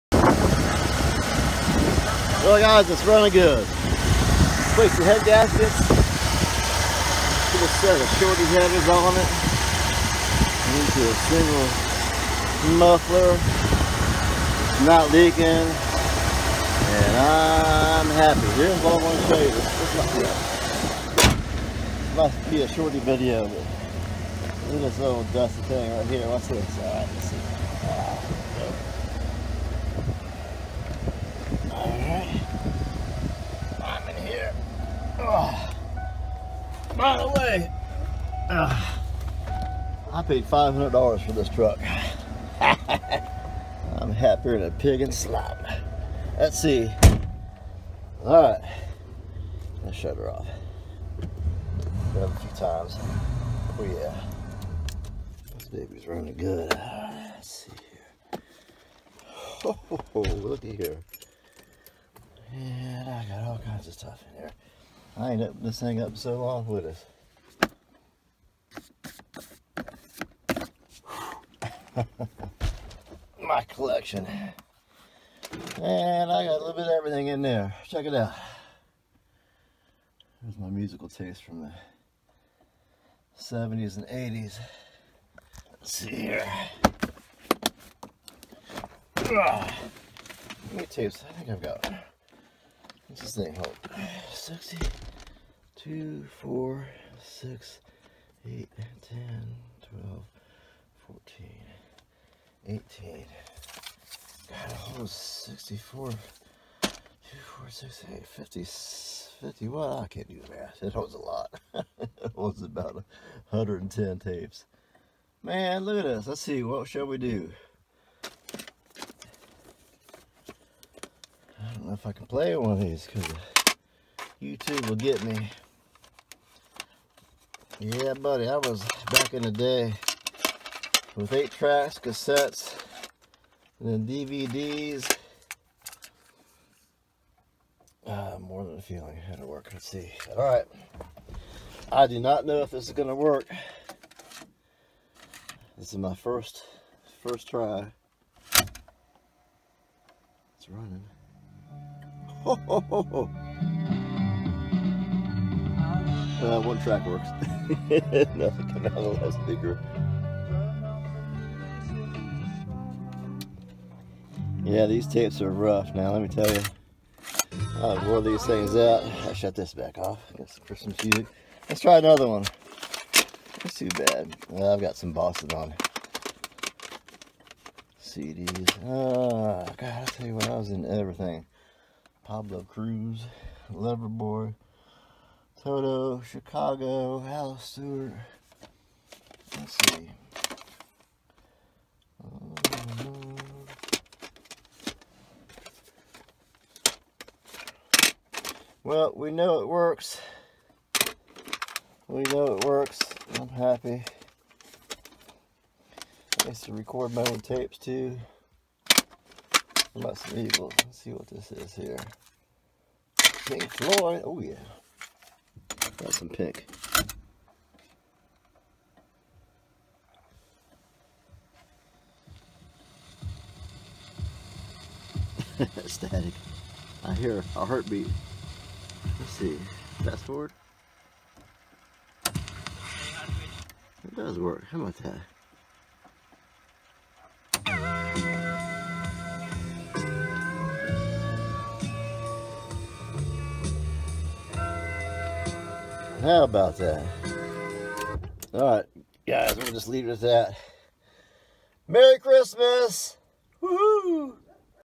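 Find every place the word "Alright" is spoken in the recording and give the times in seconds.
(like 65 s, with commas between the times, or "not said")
26 s, 248 s.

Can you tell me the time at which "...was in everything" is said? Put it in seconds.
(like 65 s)
180 s.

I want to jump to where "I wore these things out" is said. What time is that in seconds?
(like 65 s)
167 s.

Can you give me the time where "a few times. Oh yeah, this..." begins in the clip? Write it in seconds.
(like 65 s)
51 s.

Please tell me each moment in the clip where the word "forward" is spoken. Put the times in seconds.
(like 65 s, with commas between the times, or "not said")
230 s.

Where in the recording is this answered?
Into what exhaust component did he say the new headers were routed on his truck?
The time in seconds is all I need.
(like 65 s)
11 s.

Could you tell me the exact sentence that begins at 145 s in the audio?
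This is my first, first try.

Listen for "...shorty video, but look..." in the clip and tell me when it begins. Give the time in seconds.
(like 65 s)
22 s.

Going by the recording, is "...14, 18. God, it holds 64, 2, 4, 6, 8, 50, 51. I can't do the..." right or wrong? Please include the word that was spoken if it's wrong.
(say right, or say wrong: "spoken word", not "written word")
right.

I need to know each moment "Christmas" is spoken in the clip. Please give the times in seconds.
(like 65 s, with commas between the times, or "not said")
170 s, 252 s.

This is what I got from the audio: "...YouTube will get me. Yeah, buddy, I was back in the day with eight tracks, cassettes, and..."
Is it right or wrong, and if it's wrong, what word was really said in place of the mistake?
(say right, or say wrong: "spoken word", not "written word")
right.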